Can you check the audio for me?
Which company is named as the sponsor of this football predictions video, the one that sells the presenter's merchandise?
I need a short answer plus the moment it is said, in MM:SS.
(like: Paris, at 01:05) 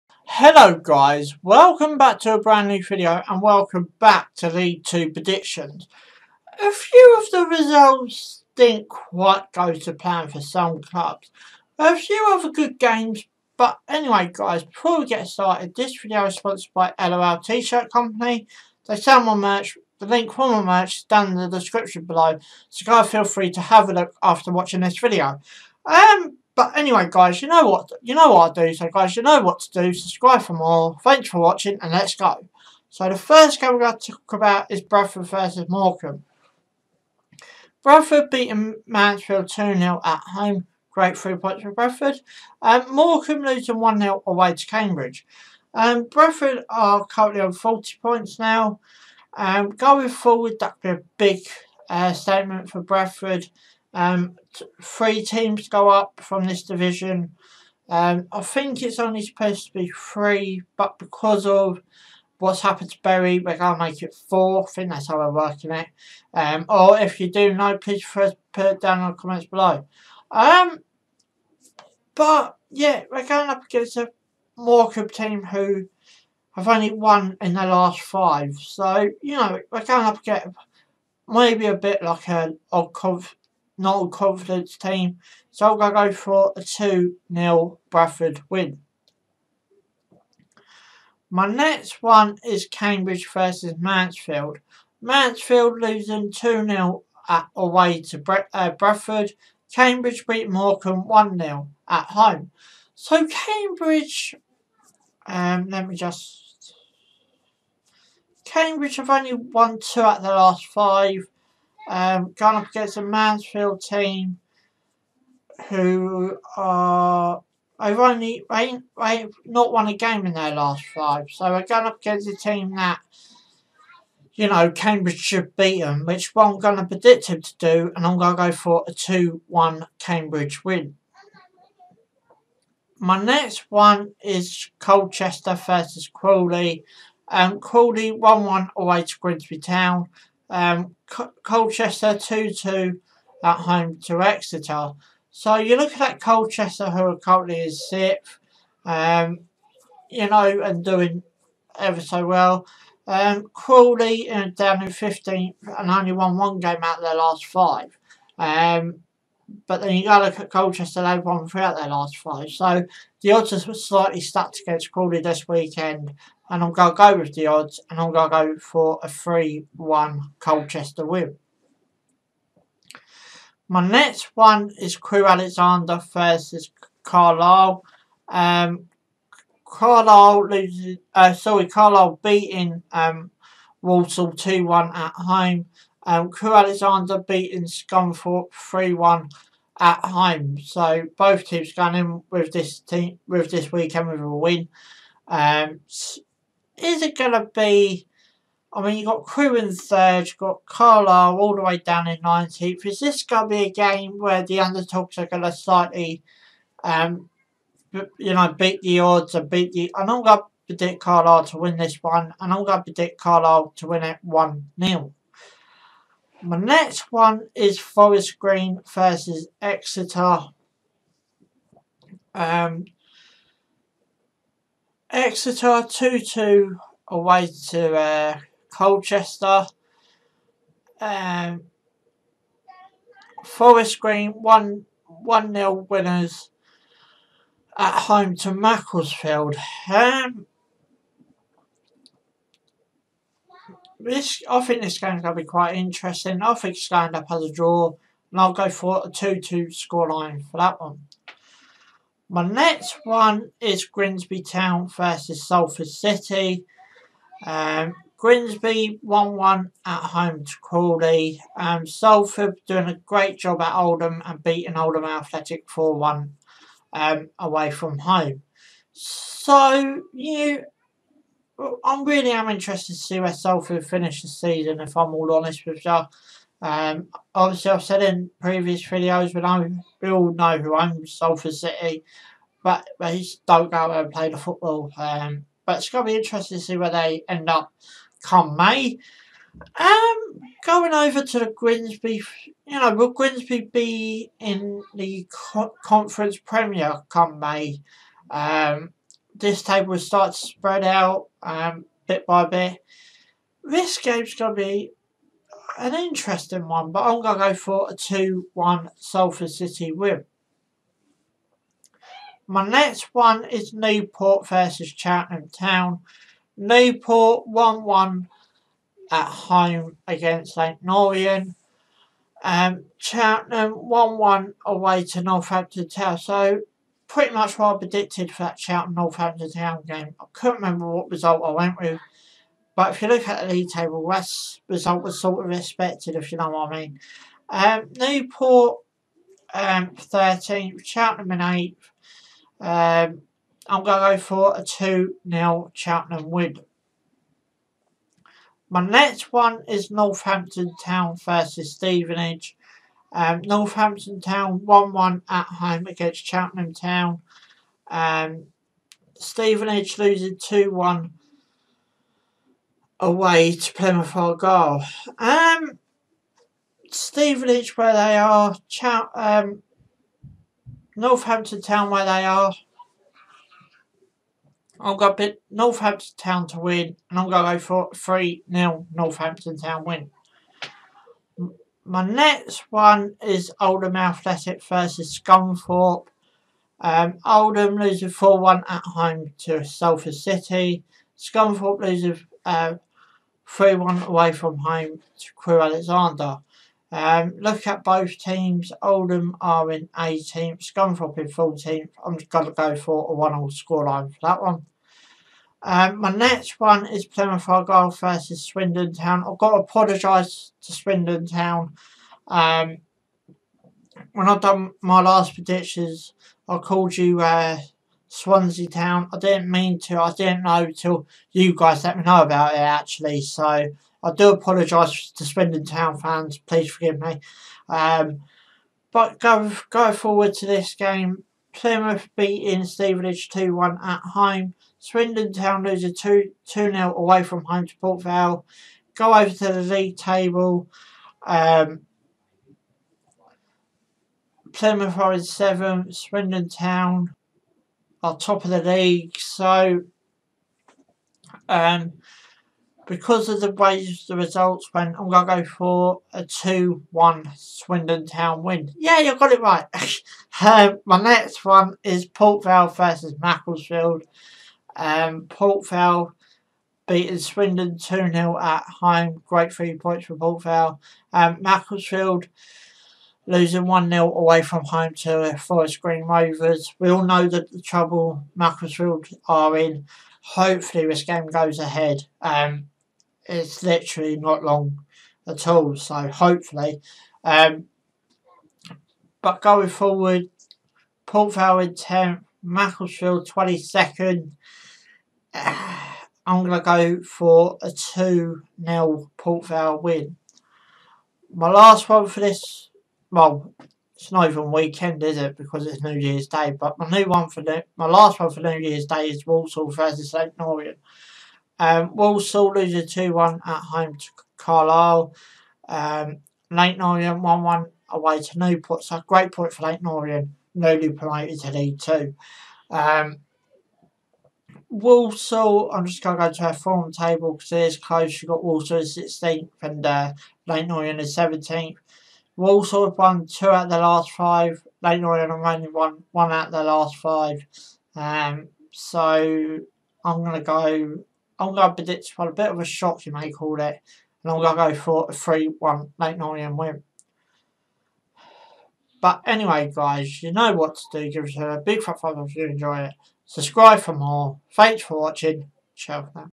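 LOL T-shirt company, at 00:16.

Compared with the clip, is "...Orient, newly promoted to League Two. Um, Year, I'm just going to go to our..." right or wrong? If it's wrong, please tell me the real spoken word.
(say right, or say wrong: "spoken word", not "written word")
wrong: "Walsall", not "Year".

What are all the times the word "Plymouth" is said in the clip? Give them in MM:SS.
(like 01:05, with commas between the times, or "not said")
06:03, 06:47, 07:11, 07:24.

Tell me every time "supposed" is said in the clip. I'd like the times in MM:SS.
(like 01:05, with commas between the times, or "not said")
00:59.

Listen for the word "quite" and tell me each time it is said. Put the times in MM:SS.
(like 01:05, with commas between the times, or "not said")
00:08, 04:05.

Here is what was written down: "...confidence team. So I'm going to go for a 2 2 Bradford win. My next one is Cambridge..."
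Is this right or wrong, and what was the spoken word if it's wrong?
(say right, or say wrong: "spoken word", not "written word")
wrong: "0", not "2".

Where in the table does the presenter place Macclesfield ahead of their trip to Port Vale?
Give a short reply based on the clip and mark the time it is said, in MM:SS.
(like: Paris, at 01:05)
22nd, at 08:13.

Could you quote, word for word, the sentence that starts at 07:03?
So I do apologise to Swindon Town fans.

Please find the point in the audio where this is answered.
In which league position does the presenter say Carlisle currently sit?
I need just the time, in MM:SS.
03:22.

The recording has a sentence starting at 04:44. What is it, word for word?
Um, but it's going to be interesting to see where they end up come May.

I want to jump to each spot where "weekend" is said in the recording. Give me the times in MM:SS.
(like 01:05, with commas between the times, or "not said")
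02:45, 03:13, 08:24.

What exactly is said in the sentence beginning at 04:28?
So, you I'm really am interested to see where Salford finish the season, if I'm all honest with you.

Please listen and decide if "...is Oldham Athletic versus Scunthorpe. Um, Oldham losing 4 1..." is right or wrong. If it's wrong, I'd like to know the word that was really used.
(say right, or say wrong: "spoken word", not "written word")
right.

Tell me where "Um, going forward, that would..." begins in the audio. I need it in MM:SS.
00:49.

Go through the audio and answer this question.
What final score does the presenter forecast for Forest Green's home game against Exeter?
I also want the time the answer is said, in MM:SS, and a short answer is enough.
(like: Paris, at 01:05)
2-2, at 04:09.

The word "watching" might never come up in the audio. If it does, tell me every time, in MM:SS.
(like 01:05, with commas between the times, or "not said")
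00:24, 00:31, 09:14.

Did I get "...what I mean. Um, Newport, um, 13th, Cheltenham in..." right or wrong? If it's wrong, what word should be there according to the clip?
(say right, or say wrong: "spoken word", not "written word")
right.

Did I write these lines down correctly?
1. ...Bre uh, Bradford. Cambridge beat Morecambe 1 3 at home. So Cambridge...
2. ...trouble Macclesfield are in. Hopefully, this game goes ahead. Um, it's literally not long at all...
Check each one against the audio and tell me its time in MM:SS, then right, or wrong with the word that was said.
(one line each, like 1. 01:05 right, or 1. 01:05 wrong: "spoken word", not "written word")
1. 01:38 wrong: "0", not "3"
2. 07:57 right.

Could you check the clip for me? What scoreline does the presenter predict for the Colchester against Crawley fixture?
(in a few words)
3-1.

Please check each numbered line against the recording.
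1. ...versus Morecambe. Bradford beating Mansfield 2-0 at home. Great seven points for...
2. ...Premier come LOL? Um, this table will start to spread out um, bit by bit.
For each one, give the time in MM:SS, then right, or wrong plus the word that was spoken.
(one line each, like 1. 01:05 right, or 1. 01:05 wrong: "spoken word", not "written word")
1. 00:35 wrong: "three", not "seven"
2. 04:56 wrong: "May", not "LOL".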